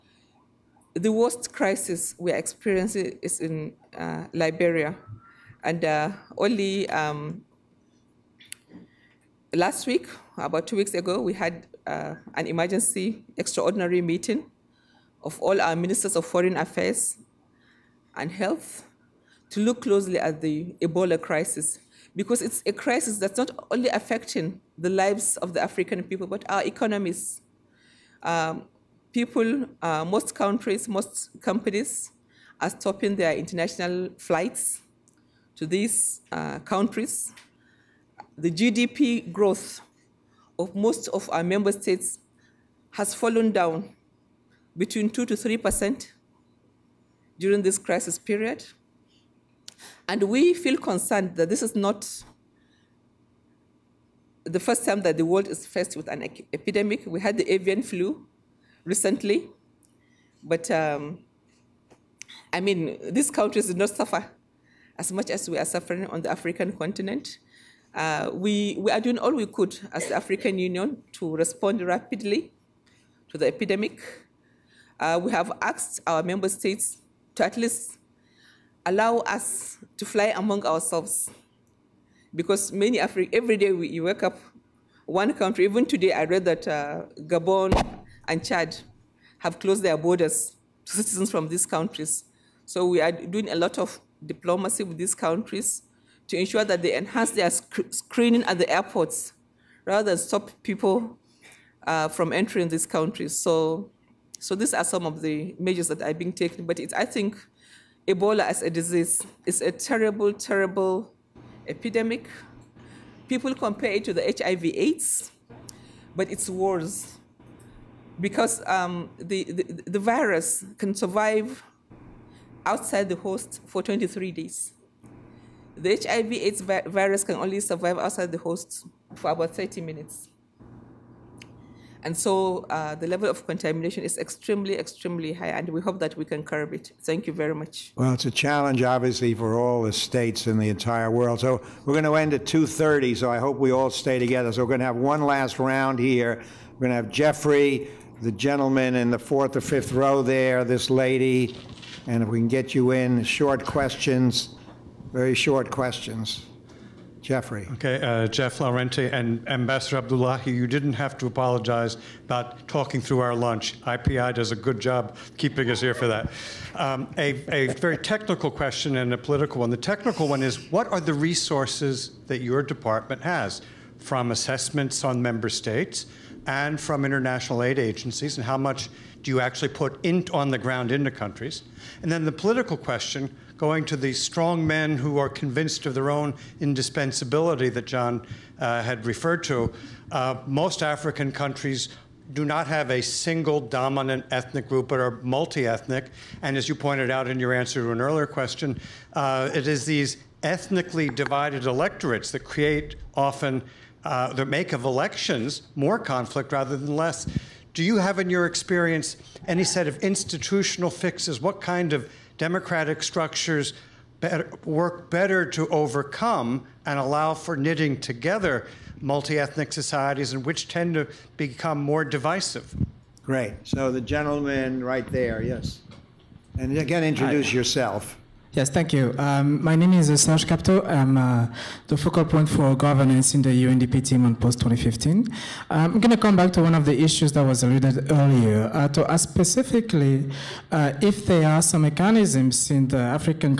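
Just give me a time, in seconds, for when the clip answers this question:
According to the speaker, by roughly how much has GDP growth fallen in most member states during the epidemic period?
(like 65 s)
45 s.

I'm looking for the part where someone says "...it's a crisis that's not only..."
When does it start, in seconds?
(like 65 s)
22 s.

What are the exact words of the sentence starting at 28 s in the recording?
Um, people, uh, most countries, most companies are stopping their international flights to these uh, countries.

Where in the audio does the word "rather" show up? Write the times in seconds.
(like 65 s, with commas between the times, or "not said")
99 s, 206 s.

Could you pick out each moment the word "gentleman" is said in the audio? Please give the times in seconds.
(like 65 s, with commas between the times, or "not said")
148 s, 224 s.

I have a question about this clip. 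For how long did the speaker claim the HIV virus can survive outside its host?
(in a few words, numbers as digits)
30 minutes.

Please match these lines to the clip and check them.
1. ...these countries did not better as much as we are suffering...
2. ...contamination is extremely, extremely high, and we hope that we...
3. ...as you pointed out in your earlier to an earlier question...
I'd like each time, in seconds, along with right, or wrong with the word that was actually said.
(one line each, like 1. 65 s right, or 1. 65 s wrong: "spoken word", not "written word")
1. 63 s wrong: "suffer", not "better"
2. 133 s right
3. 196 s wrong: "answer", not "earlier".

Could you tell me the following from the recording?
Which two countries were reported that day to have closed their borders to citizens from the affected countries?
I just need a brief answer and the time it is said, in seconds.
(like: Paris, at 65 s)
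Gabon and Chad, at 87 s.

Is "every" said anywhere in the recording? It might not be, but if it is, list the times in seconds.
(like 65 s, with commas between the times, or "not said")
83 s.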